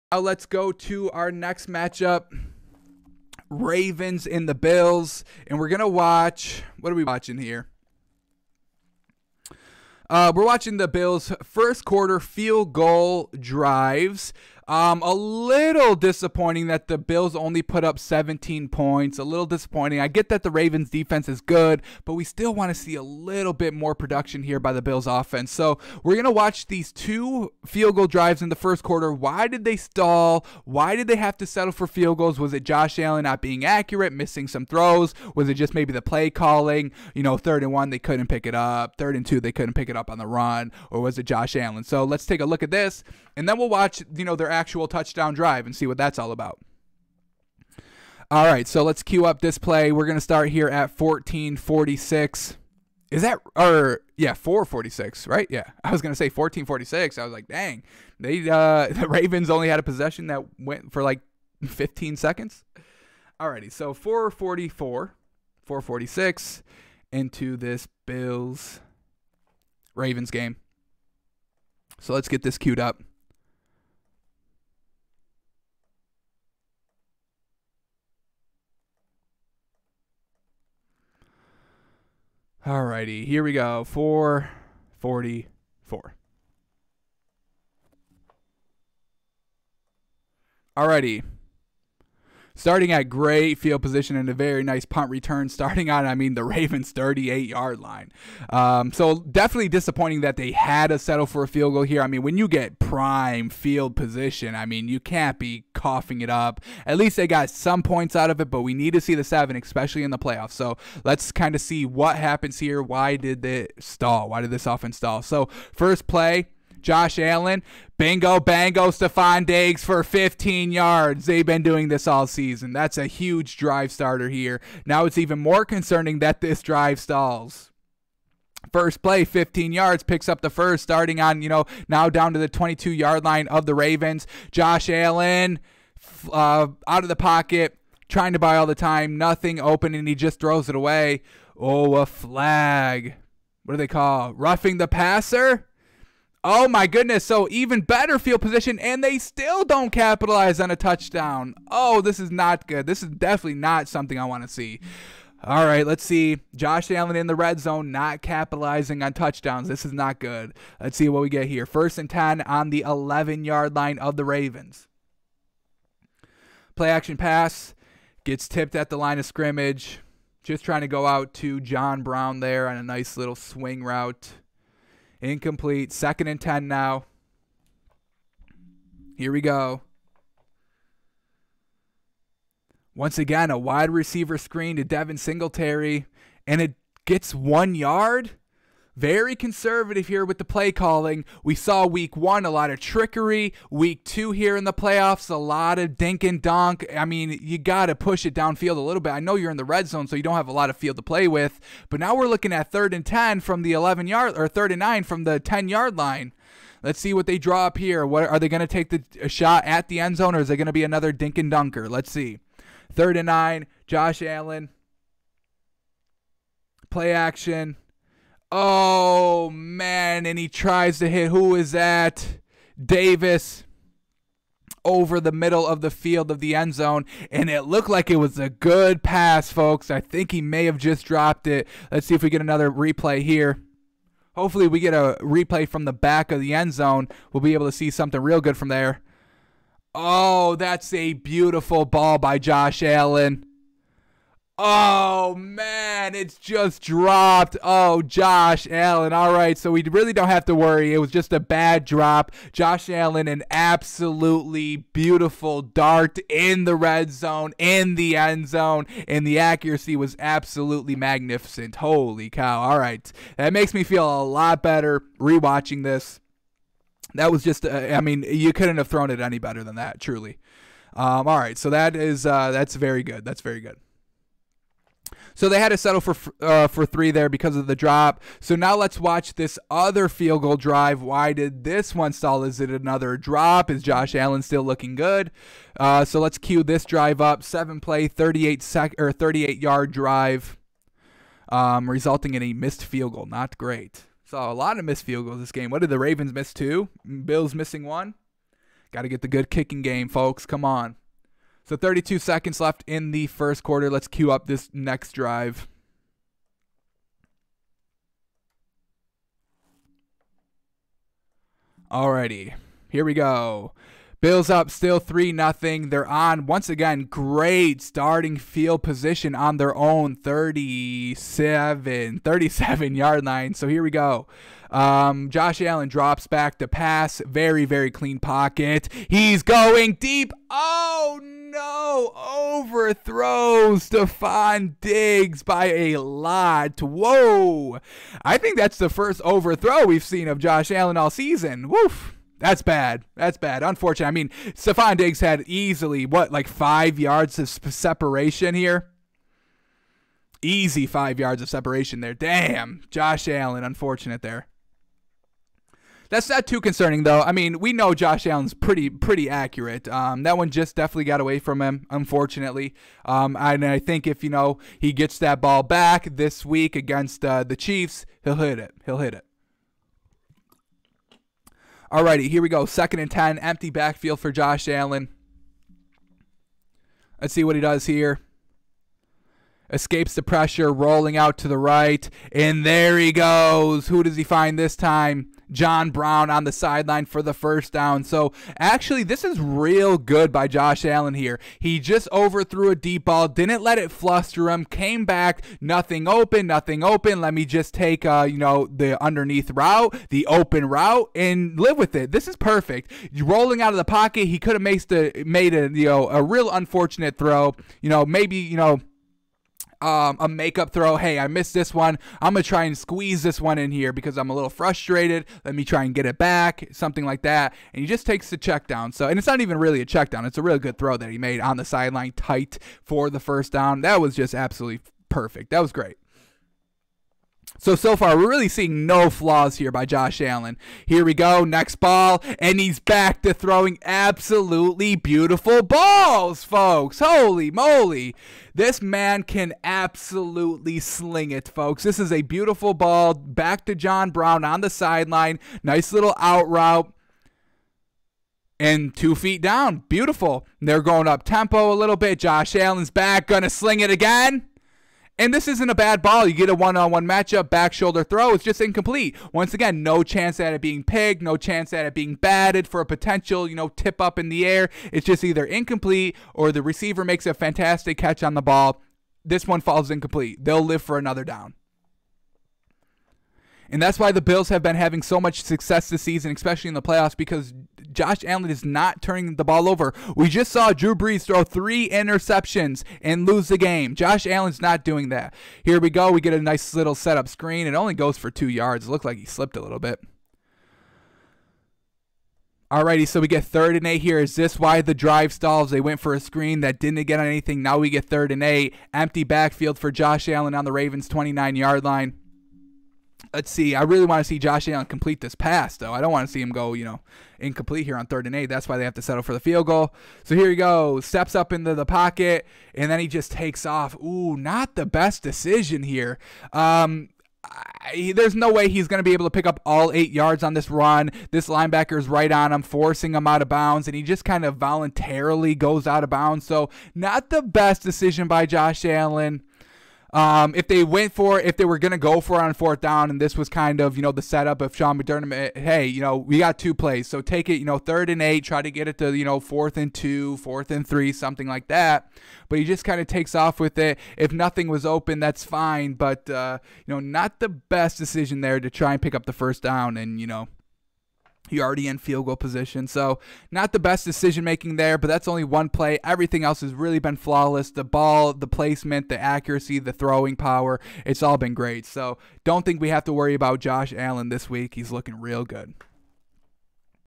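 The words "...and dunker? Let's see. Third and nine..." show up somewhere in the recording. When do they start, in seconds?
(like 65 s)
211 s.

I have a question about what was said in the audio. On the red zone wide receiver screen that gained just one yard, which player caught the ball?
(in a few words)
Devin Singletary.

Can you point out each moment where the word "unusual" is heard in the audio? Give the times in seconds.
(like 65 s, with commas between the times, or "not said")
not said.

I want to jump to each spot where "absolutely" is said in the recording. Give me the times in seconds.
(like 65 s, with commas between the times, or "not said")
253 s, 260 s, 424 s, 433 s, 439 s.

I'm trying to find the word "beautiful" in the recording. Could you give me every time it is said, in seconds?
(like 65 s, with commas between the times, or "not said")
241 s, 254 s, 434 s, 442 s, 449 s.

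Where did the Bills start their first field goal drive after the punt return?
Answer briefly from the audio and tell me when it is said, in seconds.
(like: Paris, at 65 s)
Ravens' 38, at 96 s.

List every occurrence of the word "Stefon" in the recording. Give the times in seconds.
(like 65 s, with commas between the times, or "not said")
118 s, 333 s, 344 s.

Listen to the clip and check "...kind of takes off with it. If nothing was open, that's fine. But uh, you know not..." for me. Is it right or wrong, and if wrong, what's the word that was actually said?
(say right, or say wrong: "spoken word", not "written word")
right.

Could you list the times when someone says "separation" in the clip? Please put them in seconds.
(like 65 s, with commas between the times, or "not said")
347 s, 351 s.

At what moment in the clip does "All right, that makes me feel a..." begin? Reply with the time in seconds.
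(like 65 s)
262 s.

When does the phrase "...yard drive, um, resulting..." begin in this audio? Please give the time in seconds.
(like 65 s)
289 s.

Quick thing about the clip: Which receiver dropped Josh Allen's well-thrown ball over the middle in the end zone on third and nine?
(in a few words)
Davis.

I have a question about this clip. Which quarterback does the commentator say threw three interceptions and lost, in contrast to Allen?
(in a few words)
Drew Brees.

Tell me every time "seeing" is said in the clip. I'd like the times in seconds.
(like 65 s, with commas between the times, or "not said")
428 s.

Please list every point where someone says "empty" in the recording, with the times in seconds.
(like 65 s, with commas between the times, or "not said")
373 s, 498 s.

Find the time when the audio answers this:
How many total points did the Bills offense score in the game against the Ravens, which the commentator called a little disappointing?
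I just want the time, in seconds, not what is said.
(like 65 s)
17 s.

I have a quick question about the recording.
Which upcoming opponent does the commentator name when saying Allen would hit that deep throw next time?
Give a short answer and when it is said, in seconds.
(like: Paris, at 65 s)
Chiefs, at 367 s.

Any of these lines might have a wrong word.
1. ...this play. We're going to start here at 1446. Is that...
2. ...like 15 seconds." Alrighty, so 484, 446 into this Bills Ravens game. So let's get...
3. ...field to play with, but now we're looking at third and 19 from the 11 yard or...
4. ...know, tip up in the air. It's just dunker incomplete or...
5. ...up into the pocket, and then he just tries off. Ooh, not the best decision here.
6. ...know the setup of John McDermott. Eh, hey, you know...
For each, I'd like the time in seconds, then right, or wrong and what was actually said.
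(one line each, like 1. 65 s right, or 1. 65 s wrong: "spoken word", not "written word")
1. 49 s right
2. 61 s wrong: "444", not "484"
3. 200 s wrong: "10", not "19"
4. 463 s wrong: "either", not "dunker"
5. 511 s wrong: "takes", not "tries"
6. 534 s wrong: "Sean", not "John".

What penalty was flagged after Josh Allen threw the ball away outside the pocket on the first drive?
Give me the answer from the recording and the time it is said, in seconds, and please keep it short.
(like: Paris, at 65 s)
Roughing the passer, at 144 s.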